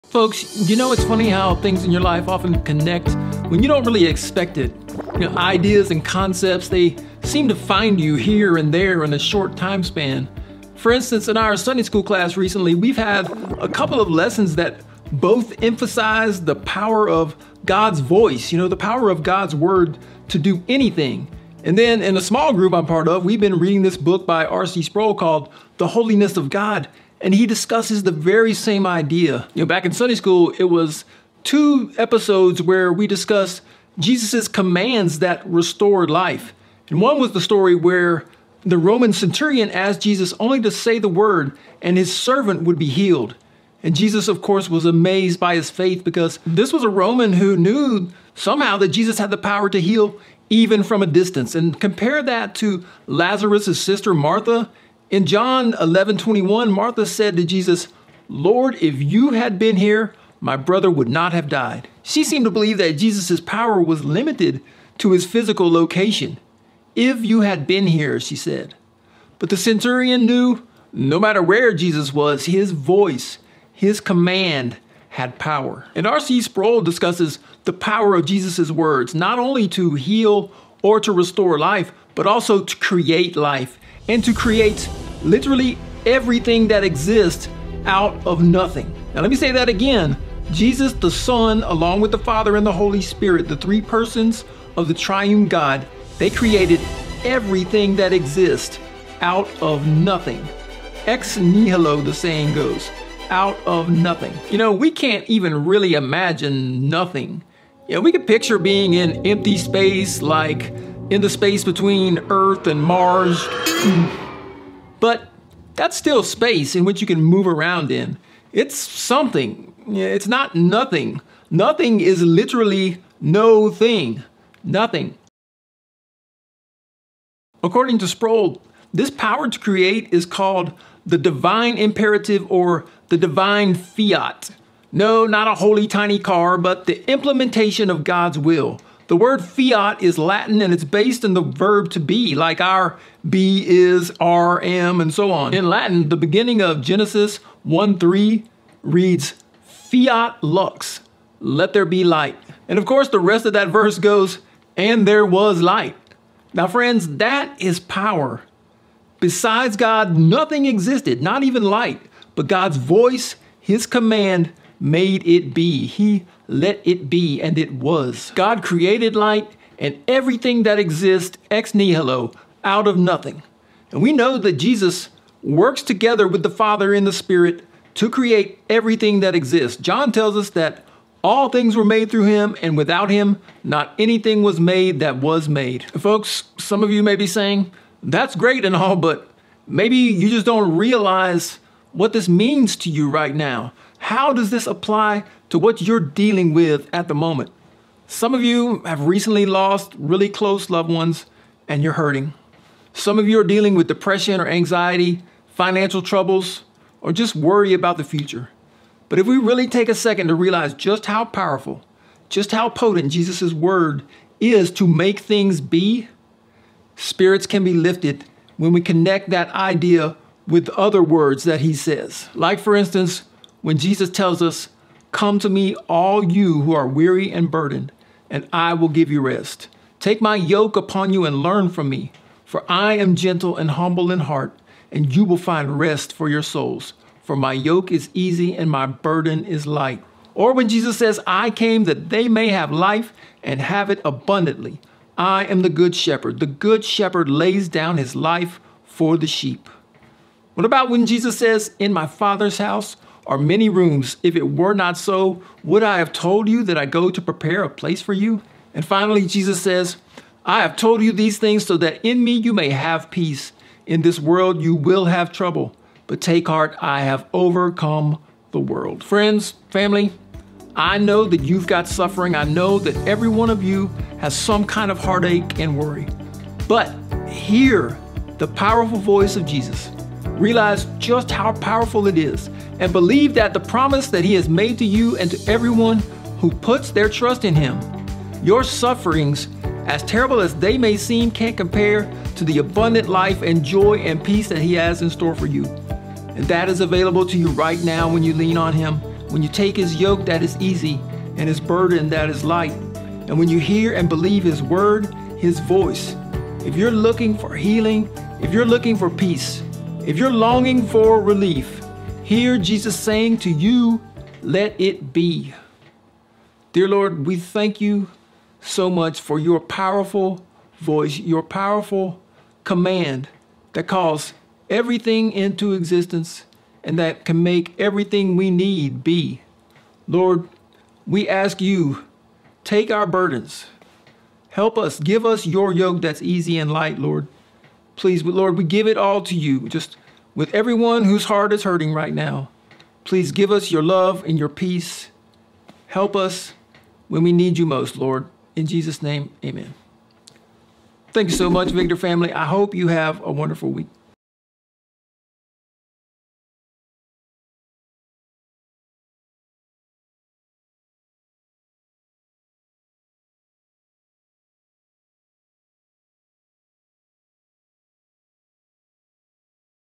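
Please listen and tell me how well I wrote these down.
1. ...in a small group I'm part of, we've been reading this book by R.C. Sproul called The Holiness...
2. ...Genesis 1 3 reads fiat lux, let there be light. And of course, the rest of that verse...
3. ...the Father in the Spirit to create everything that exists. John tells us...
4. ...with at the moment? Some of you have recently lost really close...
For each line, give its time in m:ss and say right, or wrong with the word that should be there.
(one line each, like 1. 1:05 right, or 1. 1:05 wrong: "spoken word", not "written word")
1. 0:22 right
2. 2:26 right
3. 2:56 right
4. 3:16 right.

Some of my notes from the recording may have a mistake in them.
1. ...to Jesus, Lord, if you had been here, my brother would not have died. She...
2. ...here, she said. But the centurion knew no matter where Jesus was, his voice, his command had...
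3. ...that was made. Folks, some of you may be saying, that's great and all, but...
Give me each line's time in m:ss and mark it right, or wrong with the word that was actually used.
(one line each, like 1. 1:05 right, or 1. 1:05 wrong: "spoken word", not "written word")
1. 0:57 right
2. 1:07 right
3. 3:04 right.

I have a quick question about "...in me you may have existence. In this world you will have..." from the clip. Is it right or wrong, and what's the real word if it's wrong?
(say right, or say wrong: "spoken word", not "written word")
wrong: "peace", not "existence".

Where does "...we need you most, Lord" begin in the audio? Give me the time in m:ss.
5:47.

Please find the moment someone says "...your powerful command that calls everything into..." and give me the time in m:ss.
5:21.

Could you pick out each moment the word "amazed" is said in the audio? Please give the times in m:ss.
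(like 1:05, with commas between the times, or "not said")
0:44.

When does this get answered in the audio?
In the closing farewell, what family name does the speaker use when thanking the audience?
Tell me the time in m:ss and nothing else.
5:51.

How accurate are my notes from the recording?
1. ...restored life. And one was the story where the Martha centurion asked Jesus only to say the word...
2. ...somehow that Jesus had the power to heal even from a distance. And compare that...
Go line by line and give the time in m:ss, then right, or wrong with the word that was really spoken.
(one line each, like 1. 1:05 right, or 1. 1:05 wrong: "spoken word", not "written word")
1. 0:35 wrong: "Roman", not "Martha"
2. 0:48 right.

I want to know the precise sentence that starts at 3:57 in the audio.
For my yoke is easy and my burden is light.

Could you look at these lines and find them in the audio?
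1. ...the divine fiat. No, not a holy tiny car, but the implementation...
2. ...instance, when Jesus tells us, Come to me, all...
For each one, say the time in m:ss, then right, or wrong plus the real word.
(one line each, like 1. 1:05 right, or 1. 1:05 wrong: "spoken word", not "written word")
1. 2:13 right
2. 3:42 right.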